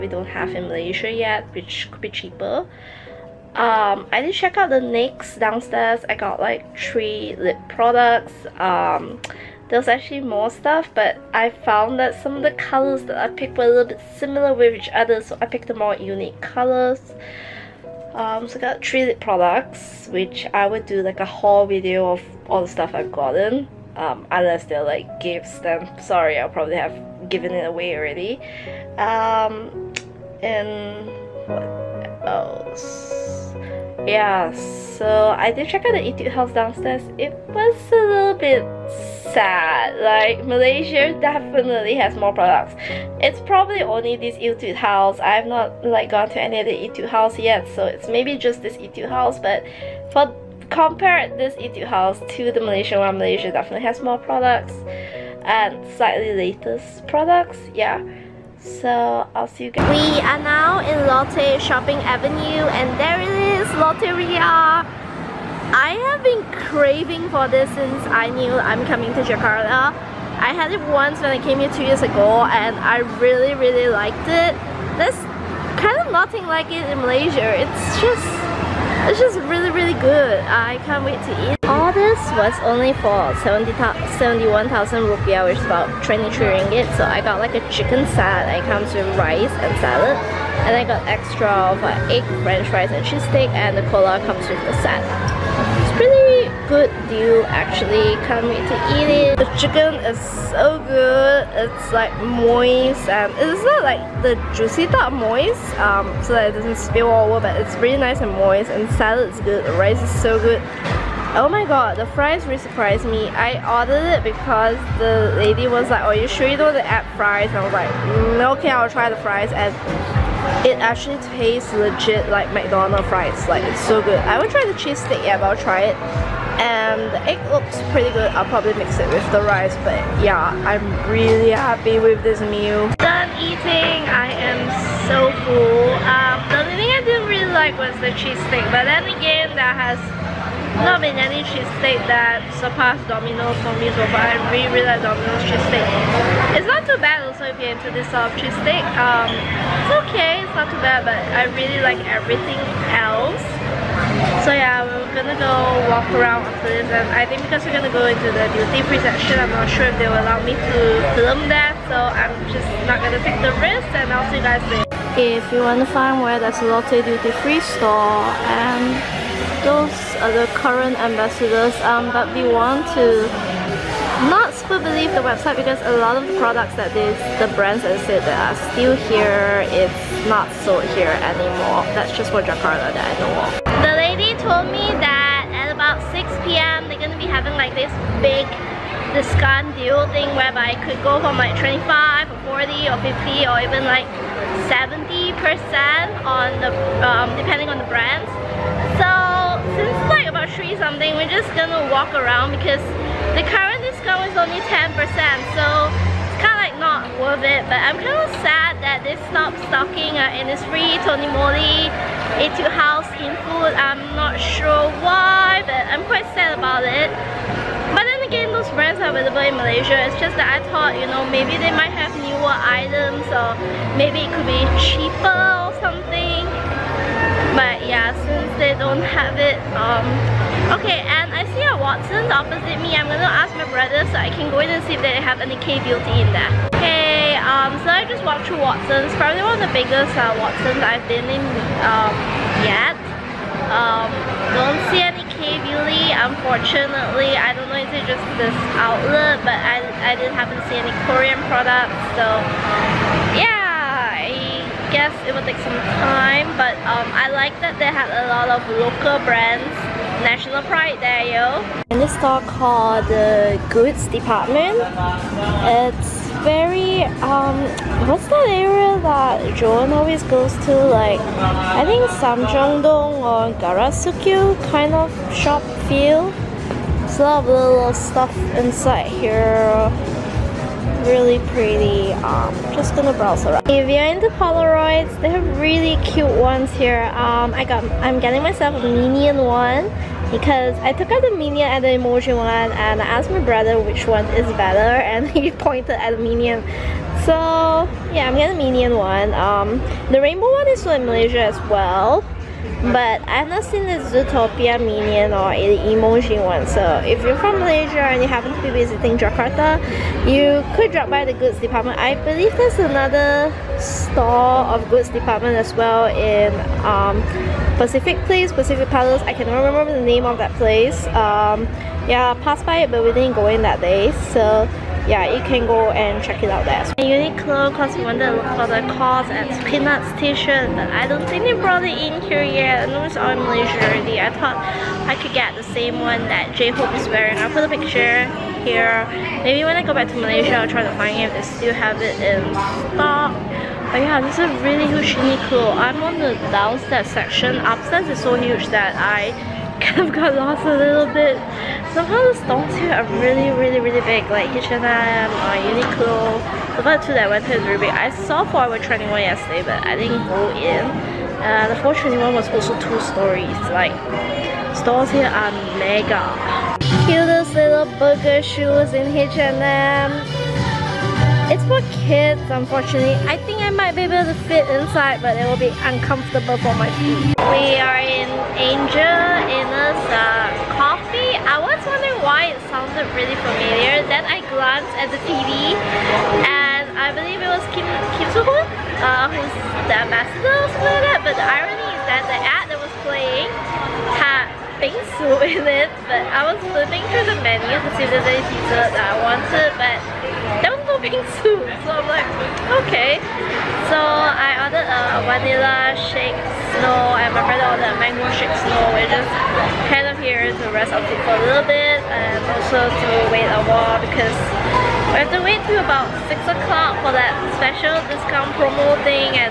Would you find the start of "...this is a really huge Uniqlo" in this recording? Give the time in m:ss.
5:44.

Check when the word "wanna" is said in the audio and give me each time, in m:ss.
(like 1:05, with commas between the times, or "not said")
2:45.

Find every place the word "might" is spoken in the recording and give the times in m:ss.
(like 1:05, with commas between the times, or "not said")
3:41, 6:13.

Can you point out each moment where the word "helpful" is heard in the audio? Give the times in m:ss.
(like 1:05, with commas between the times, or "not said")
not said.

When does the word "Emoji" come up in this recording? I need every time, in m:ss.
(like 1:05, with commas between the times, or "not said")
4:51, 5:05.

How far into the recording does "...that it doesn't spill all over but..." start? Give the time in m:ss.
1:46.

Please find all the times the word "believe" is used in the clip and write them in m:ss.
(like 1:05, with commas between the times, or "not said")
2:54, 5:12, 6:27.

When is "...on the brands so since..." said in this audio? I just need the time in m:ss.
3:17.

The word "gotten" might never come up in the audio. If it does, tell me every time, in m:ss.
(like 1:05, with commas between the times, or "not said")
0:23.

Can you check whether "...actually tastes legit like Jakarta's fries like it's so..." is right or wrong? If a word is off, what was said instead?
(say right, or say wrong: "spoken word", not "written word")
wrong: "McDonald", not "Jakarta".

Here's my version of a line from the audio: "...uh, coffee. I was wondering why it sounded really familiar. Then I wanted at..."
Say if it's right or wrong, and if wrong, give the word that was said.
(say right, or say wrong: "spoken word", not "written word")
wrong: "glanced", not "wanted".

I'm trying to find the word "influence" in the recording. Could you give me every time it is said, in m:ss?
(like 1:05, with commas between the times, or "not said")
not said.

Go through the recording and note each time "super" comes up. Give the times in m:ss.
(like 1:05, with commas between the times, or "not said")
2:54.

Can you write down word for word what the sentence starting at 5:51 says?
Somehow the stalls here are really, really, really big, like H&M or Uniqlo.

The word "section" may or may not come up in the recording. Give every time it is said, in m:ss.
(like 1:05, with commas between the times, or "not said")
2:39, 5:47.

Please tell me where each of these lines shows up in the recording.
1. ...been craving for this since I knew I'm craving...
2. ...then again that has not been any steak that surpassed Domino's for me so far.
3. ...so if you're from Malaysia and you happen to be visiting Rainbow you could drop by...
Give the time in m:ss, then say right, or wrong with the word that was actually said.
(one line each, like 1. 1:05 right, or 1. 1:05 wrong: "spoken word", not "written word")
1. 1:06 wrong: "coming", not "craving"
2. 2:18 right
3. 5:06 wrong: "Jakarta", not "Rainbow".